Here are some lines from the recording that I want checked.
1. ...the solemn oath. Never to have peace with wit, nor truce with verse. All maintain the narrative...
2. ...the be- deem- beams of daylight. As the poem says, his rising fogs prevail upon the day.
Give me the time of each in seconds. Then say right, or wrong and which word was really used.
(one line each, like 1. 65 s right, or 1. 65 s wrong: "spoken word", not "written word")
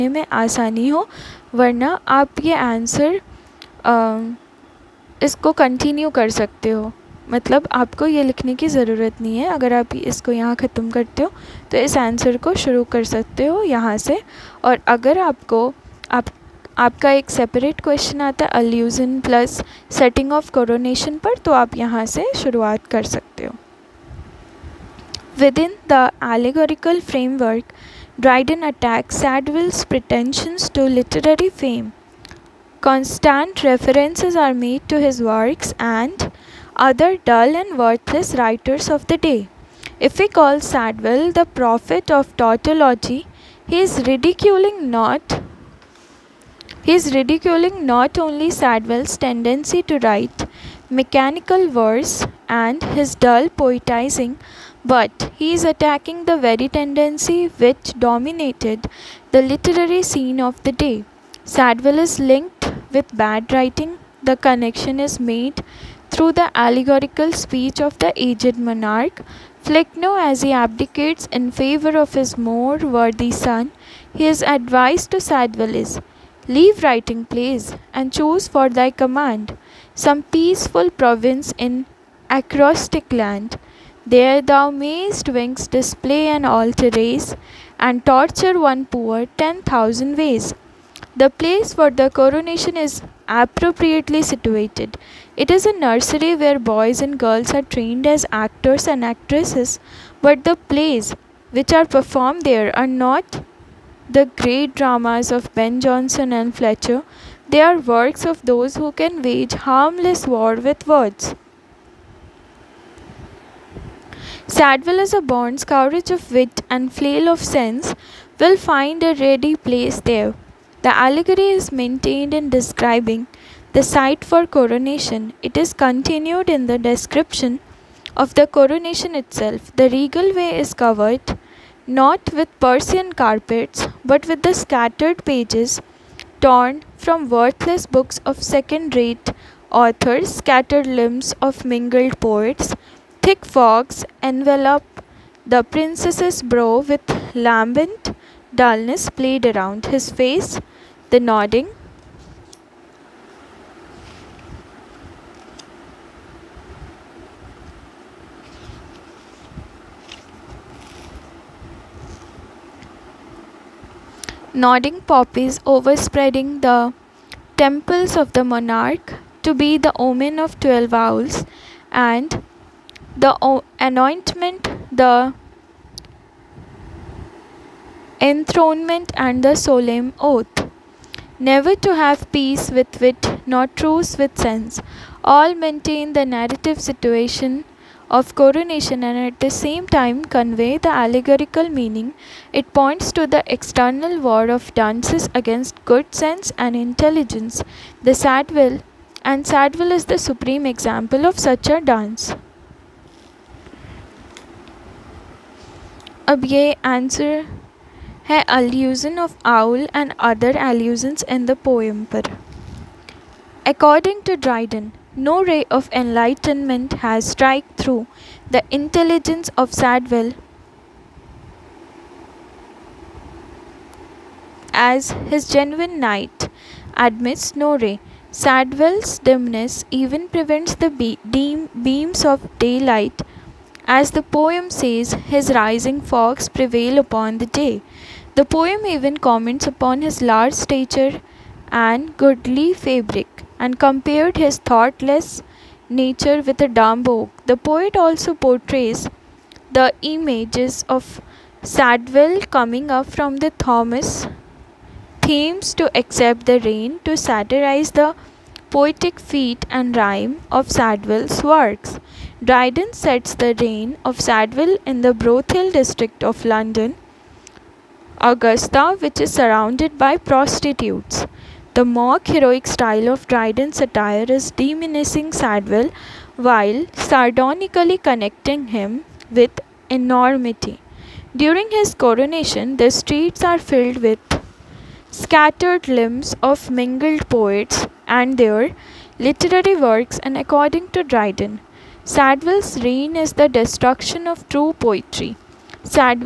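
1. 179 s wrong: "sense", not "verse"
2. 230 s right.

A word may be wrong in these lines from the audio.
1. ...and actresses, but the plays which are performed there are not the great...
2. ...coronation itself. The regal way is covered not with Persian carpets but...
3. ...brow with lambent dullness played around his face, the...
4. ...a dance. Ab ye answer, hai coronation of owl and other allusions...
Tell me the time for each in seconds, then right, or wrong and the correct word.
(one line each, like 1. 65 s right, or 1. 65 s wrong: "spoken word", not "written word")
1. 98 s right
2. 128 s right
3. 146 s right
4. 201 s wrong: "allusion", not "coronation".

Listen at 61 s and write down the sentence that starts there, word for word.
Sadwell is linked with bad writing.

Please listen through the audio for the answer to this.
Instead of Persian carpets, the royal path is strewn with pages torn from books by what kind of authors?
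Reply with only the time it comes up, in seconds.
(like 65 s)
138 s.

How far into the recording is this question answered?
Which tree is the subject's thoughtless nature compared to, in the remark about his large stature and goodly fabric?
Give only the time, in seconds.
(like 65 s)
246 s.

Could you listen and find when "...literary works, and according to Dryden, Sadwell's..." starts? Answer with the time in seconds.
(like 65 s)
289 s.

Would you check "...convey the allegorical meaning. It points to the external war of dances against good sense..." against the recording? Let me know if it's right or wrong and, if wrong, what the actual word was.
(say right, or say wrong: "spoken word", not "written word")
right.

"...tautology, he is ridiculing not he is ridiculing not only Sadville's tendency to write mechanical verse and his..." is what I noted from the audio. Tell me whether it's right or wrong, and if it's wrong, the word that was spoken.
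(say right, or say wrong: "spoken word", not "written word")
right.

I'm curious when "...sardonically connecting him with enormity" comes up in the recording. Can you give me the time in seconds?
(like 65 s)
277 s.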